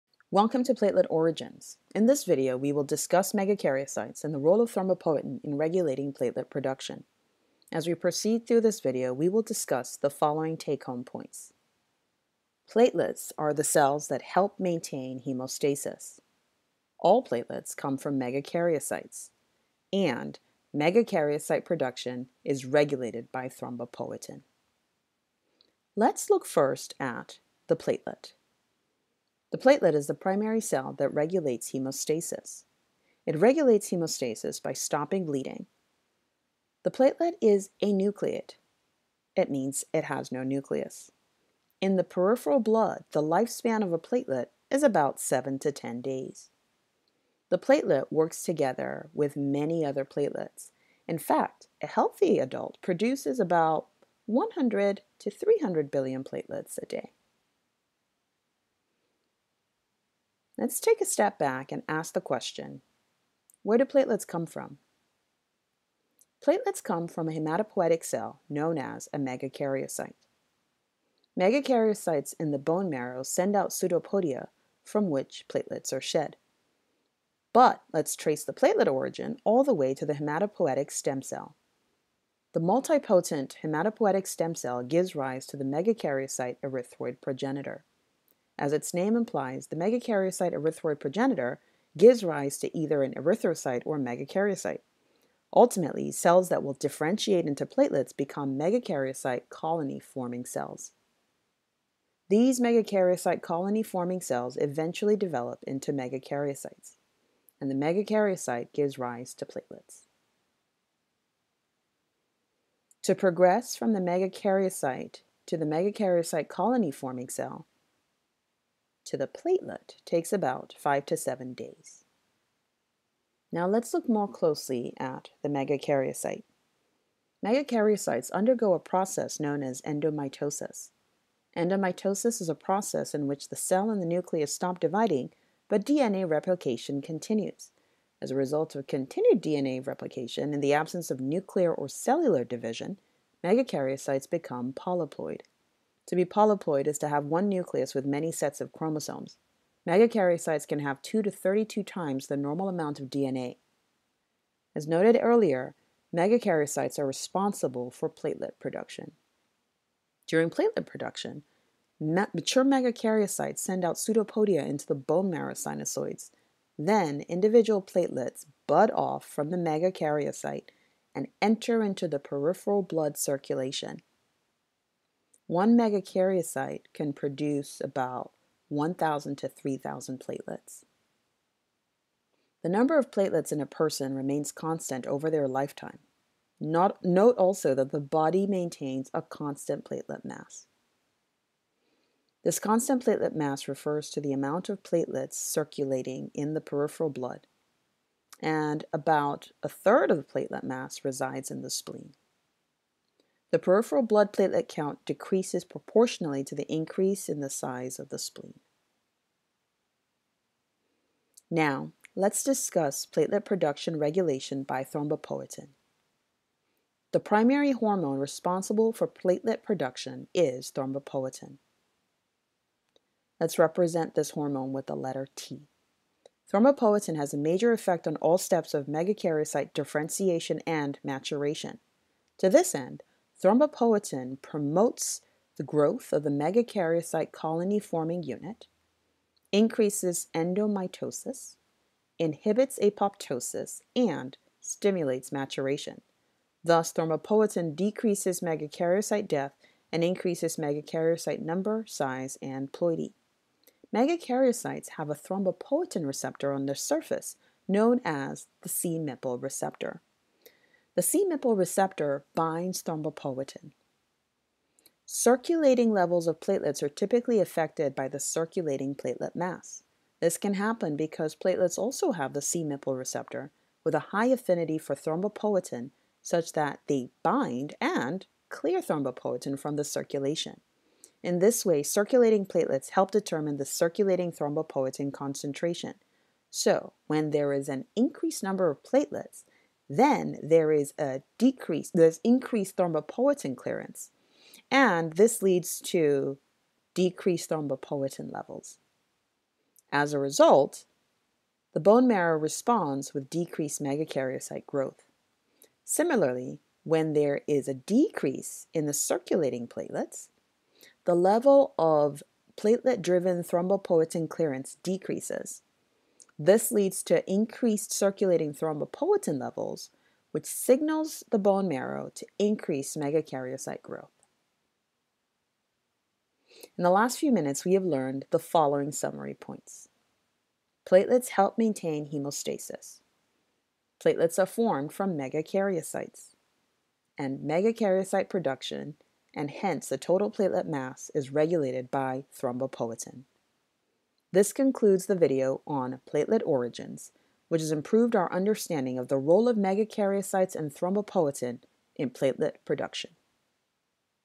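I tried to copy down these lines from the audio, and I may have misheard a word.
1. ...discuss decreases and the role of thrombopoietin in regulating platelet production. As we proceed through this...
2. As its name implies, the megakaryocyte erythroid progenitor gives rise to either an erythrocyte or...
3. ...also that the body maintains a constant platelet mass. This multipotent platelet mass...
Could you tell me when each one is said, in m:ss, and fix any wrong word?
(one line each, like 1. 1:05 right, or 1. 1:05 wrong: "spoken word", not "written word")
1. 0:02 wrong: "megakaryocytes", not "decreases"
2. 1:28 right
3. 3:07 wrong: "constant", not "multipotent".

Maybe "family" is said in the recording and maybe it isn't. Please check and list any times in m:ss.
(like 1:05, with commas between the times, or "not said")
not said.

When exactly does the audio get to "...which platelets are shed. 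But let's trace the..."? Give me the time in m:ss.
1:15.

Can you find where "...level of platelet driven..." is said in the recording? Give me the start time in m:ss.
5:11.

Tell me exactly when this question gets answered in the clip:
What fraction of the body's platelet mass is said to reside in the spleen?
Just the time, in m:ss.
3:19.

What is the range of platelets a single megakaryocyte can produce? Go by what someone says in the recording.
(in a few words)
1,000 to 3,000.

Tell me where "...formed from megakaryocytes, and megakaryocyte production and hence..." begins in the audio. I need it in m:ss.
5:34.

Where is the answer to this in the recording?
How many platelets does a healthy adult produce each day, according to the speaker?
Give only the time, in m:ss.
0:54.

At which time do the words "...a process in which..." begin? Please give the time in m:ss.
2:12.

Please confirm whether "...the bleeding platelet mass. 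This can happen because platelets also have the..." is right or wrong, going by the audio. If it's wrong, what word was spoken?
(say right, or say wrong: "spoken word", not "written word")
wrong: "circulating", not "bleeding".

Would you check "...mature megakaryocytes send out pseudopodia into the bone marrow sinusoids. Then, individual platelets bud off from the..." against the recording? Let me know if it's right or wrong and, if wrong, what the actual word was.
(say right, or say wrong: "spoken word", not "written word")
right.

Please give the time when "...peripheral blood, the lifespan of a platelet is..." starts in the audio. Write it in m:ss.
0:42.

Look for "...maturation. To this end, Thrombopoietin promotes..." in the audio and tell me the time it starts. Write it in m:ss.
3:51.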